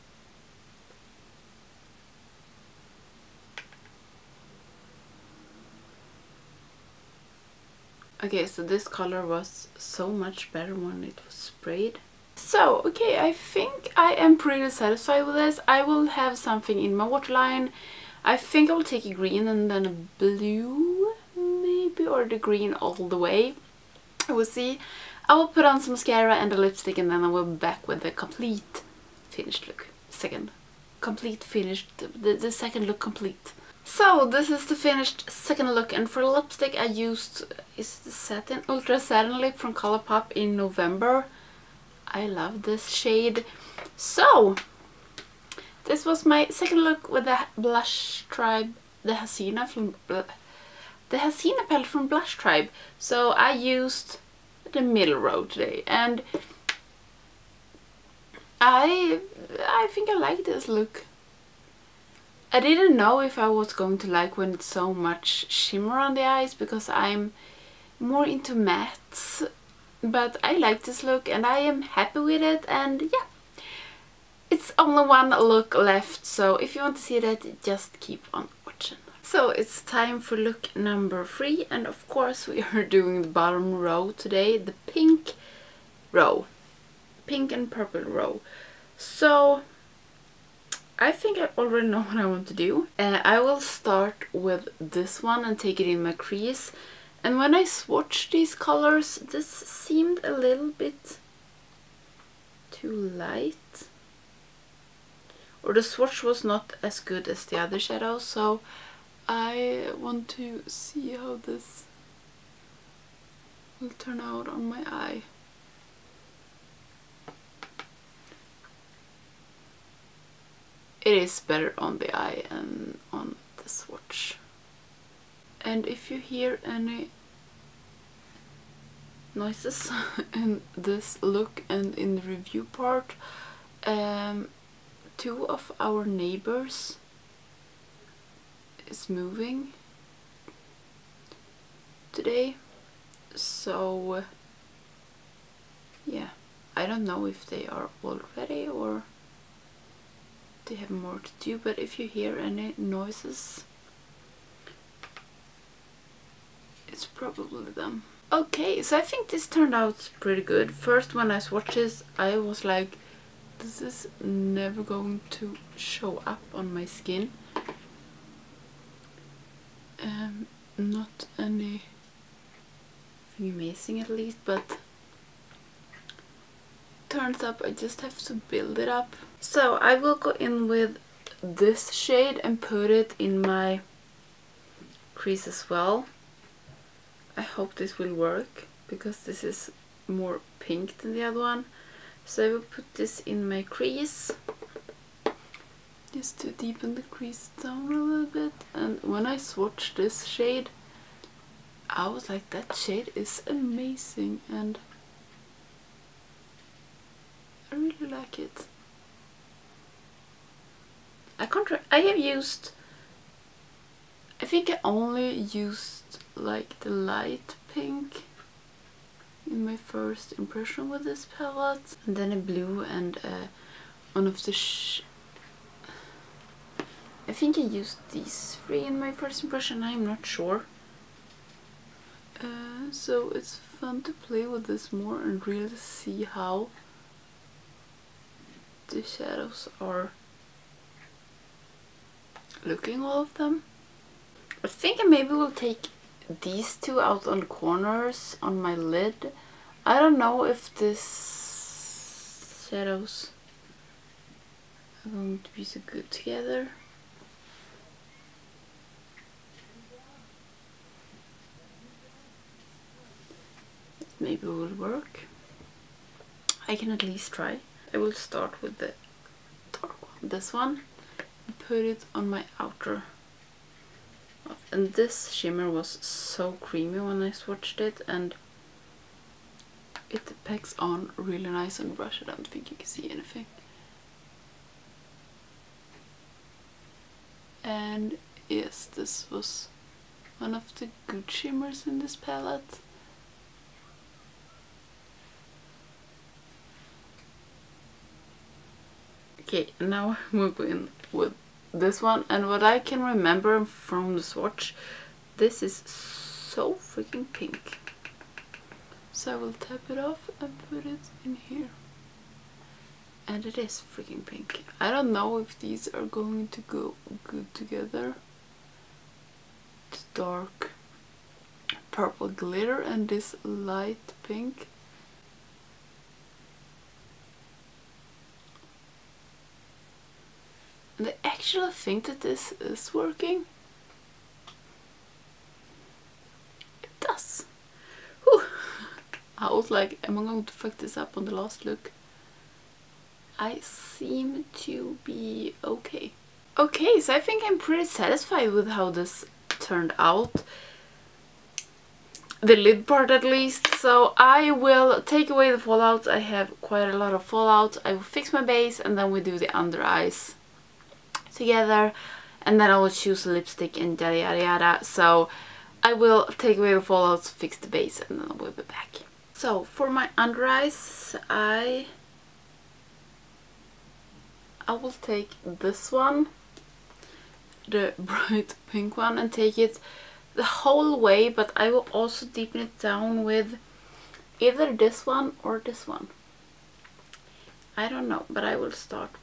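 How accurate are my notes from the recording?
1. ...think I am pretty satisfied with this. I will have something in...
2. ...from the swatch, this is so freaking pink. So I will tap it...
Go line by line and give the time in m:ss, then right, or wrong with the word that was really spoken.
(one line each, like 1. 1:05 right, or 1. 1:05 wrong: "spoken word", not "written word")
1. 0:13 right
2. 5:03 right.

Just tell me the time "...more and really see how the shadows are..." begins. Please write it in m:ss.
3:54.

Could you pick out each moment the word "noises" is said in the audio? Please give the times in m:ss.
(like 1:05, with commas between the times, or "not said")
2:09, 2:32.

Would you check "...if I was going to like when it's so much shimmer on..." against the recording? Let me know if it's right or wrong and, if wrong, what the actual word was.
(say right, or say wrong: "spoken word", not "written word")
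right.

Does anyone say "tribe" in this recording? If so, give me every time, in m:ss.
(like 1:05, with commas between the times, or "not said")
0:48, 0:52.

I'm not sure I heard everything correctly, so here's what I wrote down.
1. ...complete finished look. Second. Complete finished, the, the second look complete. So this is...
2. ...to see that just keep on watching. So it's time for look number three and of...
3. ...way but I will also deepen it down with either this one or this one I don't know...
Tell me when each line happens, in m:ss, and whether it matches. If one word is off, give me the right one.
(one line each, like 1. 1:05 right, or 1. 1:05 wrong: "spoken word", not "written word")
1. 0:28 right
2. 1:16 right
3. 6:20 right.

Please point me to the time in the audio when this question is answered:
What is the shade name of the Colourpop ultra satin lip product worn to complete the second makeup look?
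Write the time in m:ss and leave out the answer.
0:40.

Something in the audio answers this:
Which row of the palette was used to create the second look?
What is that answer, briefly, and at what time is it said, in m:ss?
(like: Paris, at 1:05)
middle row, at 0:54.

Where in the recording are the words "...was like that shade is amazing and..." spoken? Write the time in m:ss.
3:22.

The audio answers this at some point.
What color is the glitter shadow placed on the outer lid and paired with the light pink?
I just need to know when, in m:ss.
5:20.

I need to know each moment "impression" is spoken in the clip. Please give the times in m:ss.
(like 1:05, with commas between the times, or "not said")
3:40, 3:49.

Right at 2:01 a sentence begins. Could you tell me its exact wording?
It is better on the eye and on the swatch.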